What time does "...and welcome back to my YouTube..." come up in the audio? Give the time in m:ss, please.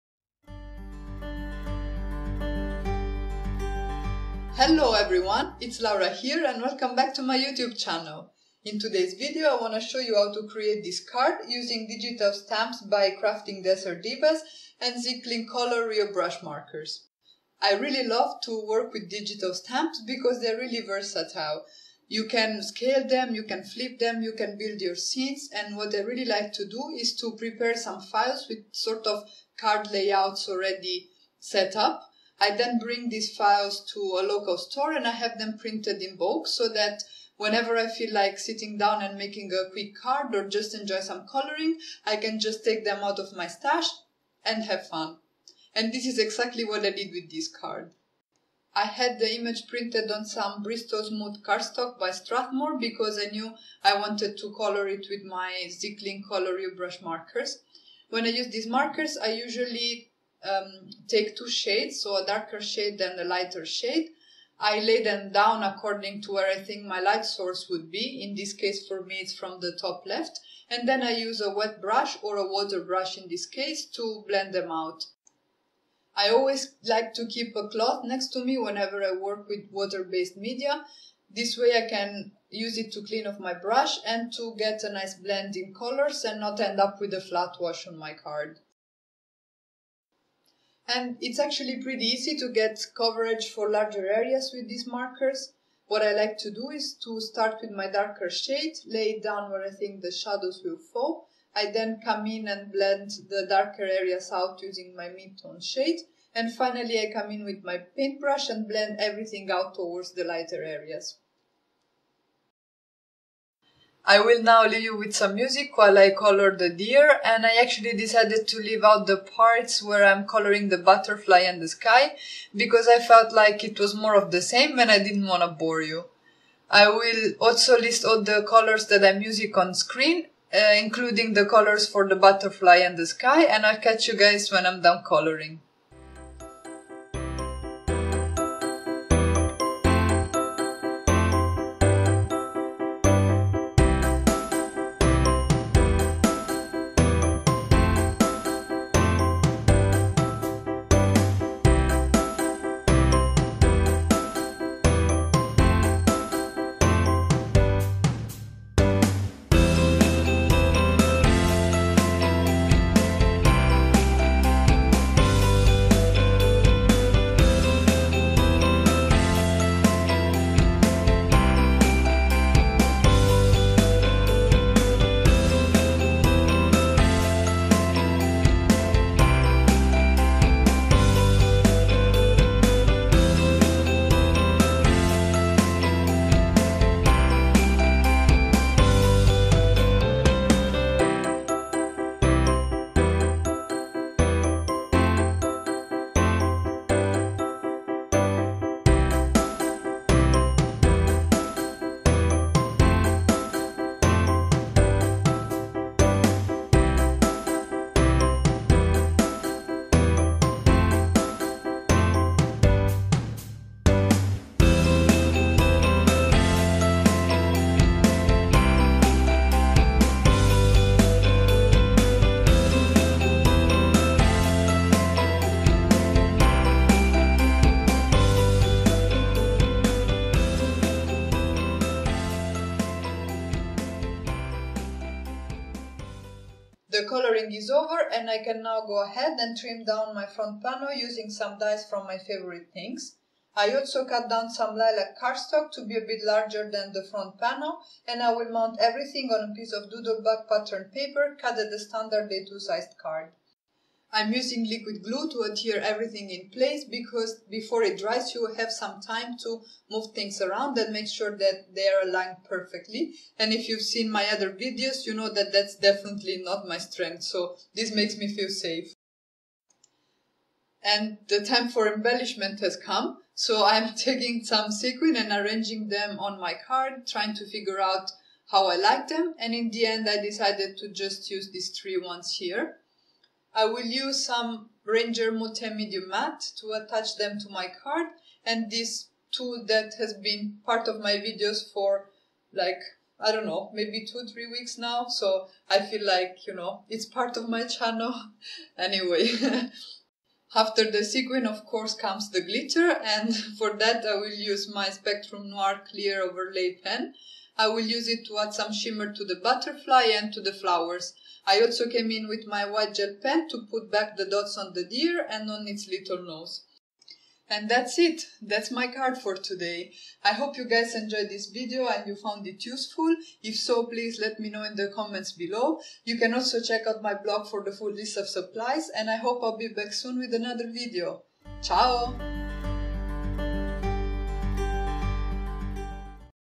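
0:06.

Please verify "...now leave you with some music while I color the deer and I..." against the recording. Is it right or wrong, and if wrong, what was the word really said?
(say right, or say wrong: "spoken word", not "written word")
right.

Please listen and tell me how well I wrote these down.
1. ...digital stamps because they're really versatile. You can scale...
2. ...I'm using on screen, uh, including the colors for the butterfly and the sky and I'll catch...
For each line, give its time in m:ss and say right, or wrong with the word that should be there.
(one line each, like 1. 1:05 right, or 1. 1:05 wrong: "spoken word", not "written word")
1. 0:19 right
2. 2:09 right.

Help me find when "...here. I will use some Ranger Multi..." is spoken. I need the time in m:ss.
4:42.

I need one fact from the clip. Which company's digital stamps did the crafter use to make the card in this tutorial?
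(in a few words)
Craftin Desert Divas.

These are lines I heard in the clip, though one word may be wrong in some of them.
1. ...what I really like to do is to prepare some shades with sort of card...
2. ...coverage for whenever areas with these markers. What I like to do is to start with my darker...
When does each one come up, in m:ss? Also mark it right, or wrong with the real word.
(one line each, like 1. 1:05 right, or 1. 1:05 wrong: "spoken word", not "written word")
1. 0:25 wrong: "files", not "shades"
2. 1:32 wrong: "larger", not "whenever".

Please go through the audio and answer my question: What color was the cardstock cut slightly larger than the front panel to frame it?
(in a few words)
lilac.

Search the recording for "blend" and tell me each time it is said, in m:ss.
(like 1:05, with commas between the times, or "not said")
1:14, 1:25, 1:42, 1:48.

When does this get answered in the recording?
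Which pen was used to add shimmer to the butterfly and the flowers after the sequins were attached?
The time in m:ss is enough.
5:04.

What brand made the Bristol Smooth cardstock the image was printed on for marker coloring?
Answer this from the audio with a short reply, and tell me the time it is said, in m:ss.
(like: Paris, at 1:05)
Strathmore, at 0:52.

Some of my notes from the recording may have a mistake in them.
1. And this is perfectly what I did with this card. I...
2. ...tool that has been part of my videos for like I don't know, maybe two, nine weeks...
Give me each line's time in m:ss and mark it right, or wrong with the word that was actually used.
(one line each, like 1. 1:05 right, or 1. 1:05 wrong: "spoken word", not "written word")
1. 0:45 wrong: "exactly", not "perfectly"
2. 4:49 wrong: "three", not "nine".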